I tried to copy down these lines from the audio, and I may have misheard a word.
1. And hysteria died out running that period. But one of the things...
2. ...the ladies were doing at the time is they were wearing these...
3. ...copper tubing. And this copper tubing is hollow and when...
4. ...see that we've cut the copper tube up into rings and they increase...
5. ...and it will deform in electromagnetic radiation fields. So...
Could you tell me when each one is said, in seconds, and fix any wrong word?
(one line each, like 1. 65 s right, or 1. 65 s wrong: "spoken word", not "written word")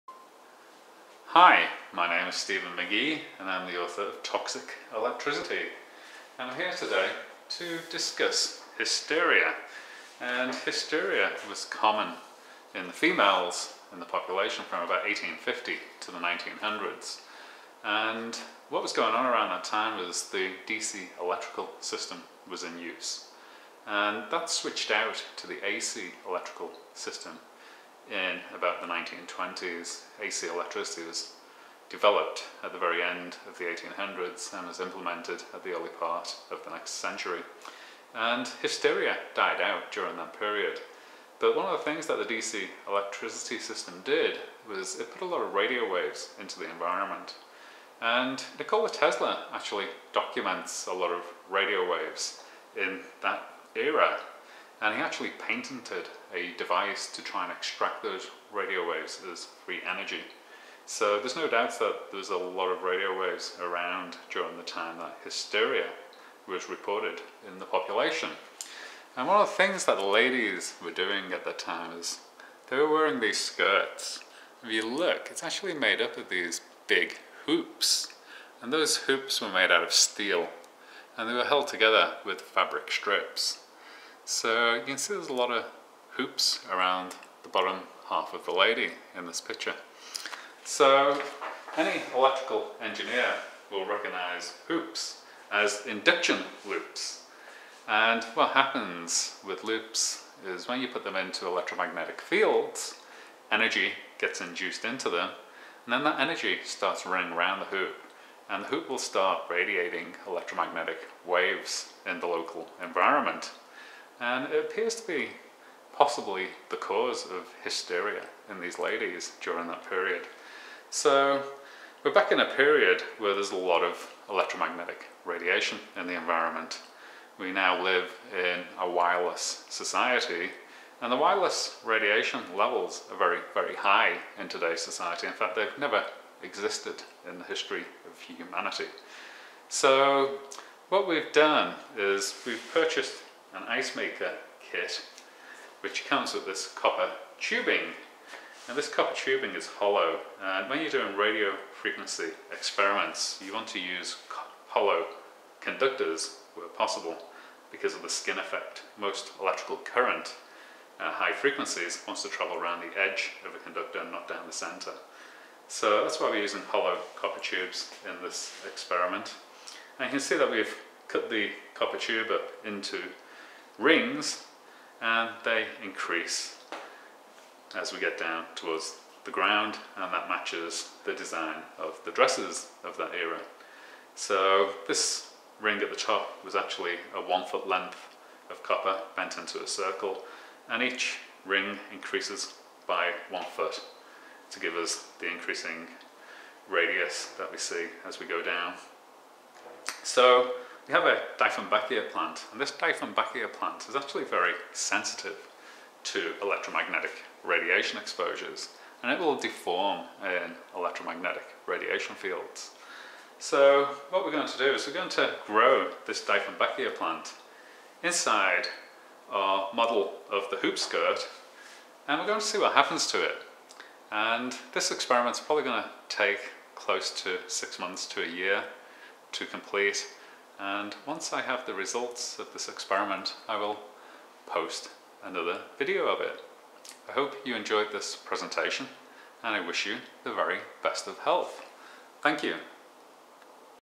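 1. 38 s wrong: "during", not "running"
2. 69 s right
3. 146 s right
4. 170 s right
5. 209 s right.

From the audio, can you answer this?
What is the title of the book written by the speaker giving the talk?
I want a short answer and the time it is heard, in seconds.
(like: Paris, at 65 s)
Toxic Electricity, at 4 s.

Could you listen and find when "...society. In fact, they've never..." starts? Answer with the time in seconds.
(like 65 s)
134 s.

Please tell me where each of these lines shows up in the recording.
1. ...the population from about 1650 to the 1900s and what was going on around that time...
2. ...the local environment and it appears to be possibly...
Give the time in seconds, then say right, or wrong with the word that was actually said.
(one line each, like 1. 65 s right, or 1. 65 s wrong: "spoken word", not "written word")
1. 14 s wrong: "1850", not "1650"
2. 112 s right.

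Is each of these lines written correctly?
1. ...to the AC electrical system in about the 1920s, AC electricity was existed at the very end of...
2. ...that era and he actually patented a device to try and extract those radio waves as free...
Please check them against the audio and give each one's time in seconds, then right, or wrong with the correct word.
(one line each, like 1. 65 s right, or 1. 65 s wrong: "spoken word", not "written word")
1. 25 s wrong: "developed", not "existed"
2. 53 s right.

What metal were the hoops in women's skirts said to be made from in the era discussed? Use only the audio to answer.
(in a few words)
Steel.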